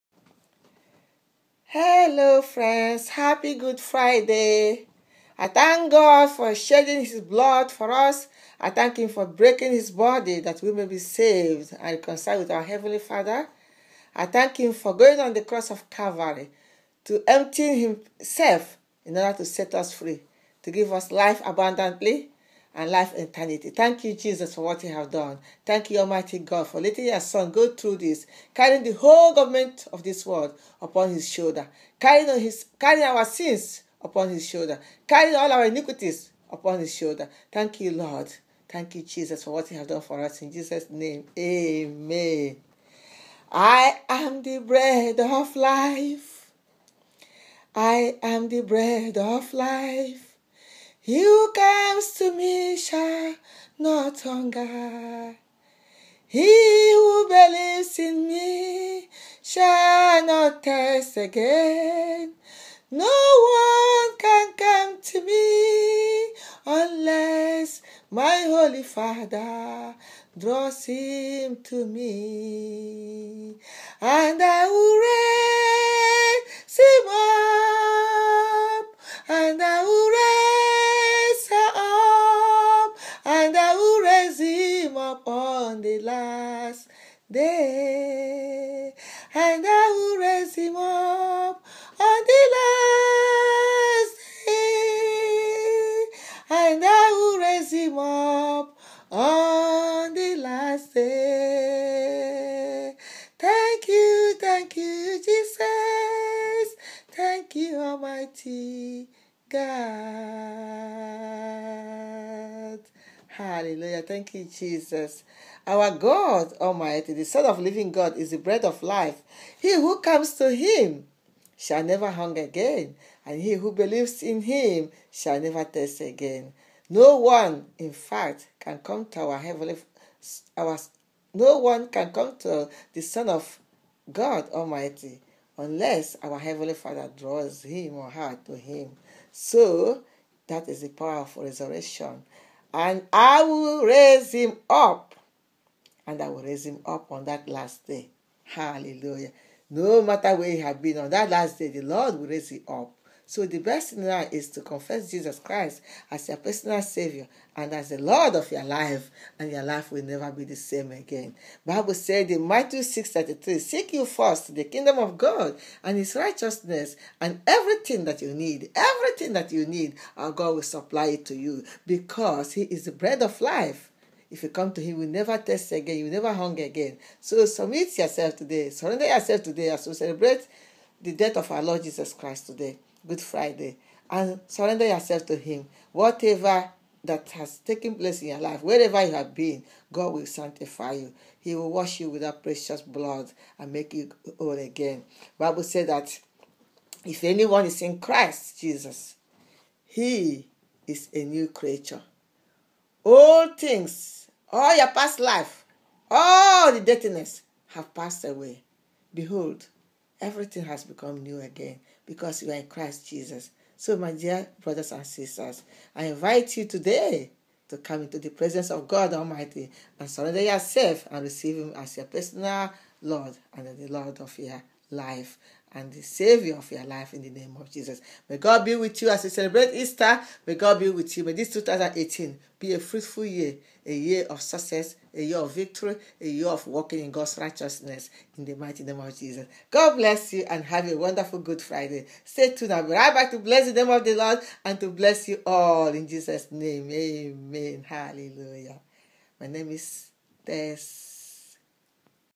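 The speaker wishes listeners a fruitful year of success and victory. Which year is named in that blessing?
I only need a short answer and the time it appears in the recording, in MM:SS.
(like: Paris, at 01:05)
2018, at 03:51.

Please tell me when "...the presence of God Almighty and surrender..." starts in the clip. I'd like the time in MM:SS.
03:38.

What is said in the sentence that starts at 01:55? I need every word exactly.
Our God Almighty, the Son of Living God, is the bread of life.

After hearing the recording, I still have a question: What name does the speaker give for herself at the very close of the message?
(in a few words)
Tess.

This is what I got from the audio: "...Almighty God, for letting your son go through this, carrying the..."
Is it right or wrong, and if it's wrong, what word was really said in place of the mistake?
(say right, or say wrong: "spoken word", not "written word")
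right.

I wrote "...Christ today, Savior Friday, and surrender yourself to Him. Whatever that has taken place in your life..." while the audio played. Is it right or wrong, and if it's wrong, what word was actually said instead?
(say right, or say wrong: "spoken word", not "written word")
wrong: "Good", not "Savior".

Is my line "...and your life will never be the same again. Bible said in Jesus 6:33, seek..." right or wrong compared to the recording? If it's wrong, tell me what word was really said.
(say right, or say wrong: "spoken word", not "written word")
wrong: "Matthew", not "Jesus".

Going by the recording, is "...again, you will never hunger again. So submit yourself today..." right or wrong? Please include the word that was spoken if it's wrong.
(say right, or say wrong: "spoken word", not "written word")
right.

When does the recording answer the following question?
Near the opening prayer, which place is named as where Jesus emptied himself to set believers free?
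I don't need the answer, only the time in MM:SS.
00:15.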